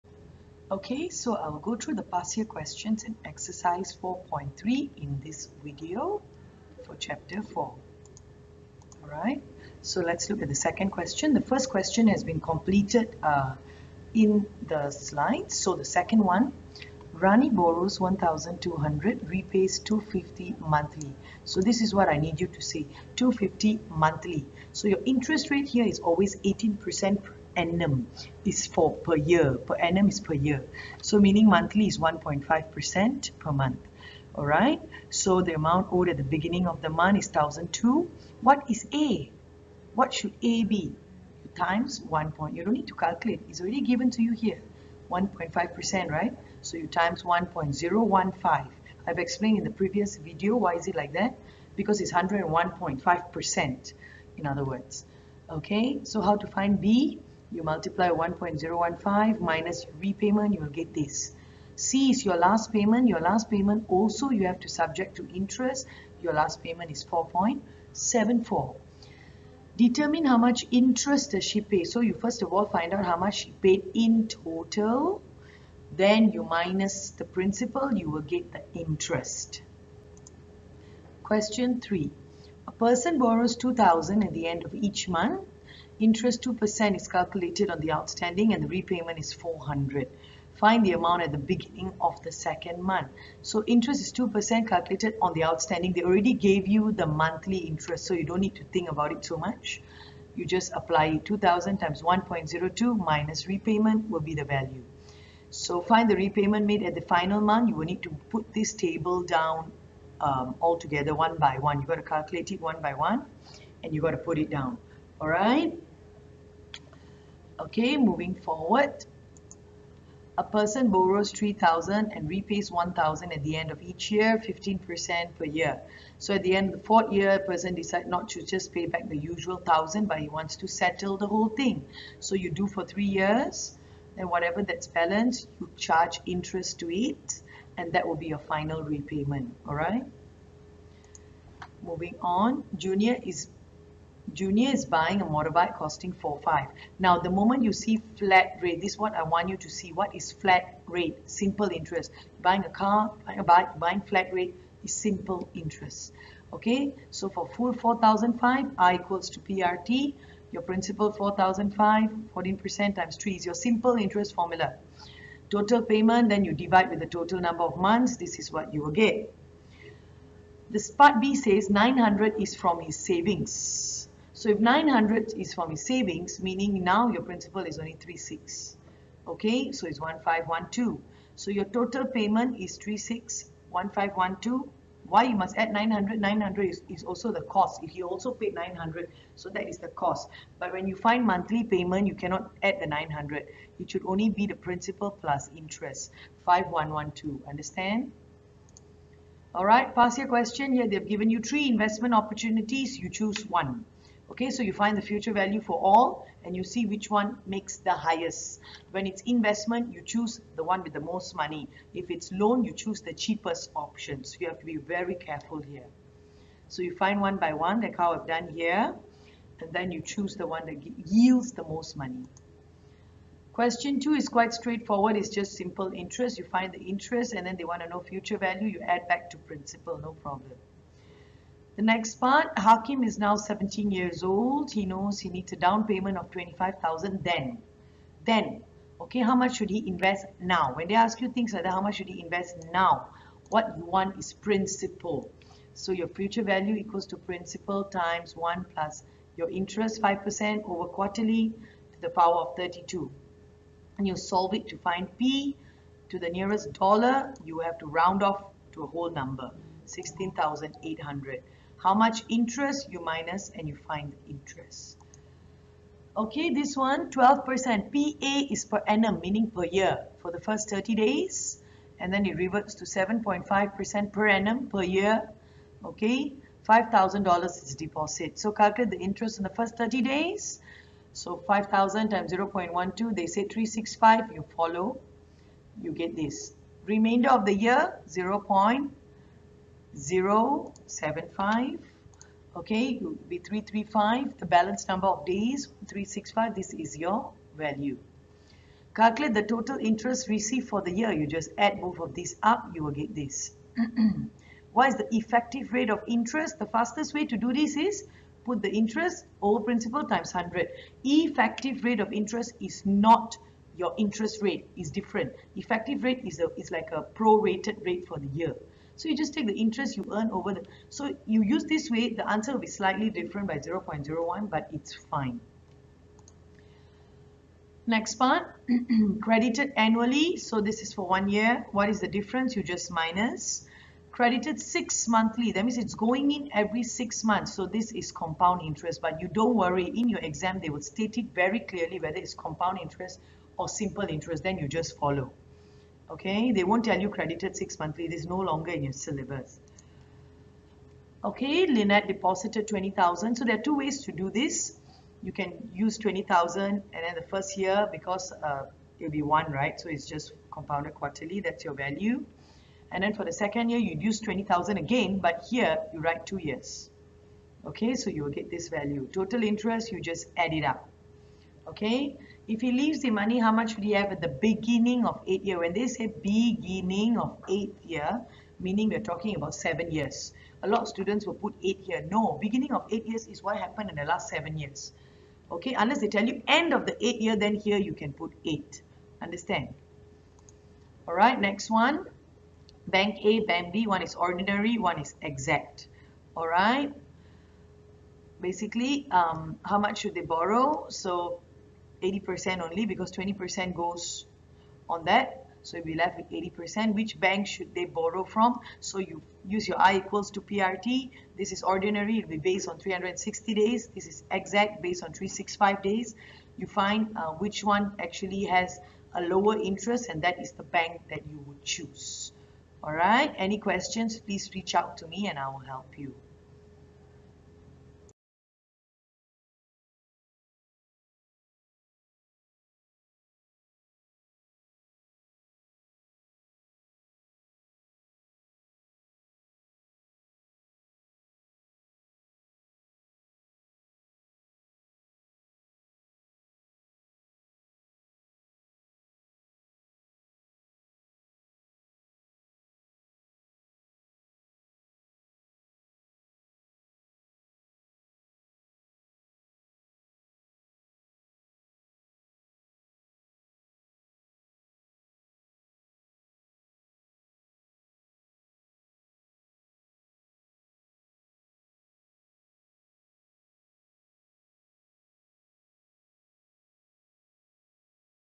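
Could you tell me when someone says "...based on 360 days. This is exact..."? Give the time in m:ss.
6:52.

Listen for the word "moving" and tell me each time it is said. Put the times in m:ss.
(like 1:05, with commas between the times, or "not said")
1:57, 2:21.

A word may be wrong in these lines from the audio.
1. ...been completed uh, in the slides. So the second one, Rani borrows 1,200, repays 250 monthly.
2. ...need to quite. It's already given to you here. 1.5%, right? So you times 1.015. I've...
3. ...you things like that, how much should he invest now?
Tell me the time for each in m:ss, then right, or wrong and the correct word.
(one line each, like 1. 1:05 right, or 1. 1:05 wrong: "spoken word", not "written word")
1. 0:12 right
2. 0:42 wrong: "calculate", not "quite"
3. 4:01 right.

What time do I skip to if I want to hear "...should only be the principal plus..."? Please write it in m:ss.
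3:13.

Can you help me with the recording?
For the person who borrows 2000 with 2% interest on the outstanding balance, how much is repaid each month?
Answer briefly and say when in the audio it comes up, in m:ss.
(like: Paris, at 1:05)
400, at 1:29.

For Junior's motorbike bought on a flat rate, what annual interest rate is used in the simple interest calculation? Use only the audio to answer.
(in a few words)
14%.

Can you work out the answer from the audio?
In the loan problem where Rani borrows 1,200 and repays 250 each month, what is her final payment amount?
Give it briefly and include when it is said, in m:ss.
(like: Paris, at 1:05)
4.74, at 1:07.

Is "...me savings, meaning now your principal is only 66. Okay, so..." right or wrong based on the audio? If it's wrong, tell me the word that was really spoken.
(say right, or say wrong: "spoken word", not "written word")
wrong: "36", not "66".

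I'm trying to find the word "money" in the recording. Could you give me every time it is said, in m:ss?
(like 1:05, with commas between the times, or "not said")
3:31, 3:41, 6:13.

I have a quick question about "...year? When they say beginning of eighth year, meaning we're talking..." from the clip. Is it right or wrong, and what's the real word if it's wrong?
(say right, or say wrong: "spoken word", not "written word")
right.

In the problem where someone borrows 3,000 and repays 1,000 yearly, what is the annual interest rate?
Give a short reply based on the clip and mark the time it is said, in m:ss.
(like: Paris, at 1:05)
15%, at 2:04.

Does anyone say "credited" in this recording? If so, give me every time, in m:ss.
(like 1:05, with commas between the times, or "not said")
5:29, 5:34, 5:47.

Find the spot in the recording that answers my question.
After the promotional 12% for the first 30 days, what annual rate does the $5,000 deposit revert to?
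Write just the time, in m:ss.
4:32.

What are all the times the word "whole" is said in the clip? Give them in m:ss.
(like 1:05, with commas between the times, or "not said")
2:11, 4:18.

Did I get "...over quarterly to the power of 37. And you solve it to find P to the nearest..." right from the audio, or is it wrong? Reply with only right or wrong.
wrong.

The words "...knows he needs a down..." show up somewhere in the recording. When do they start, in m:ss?
3:54.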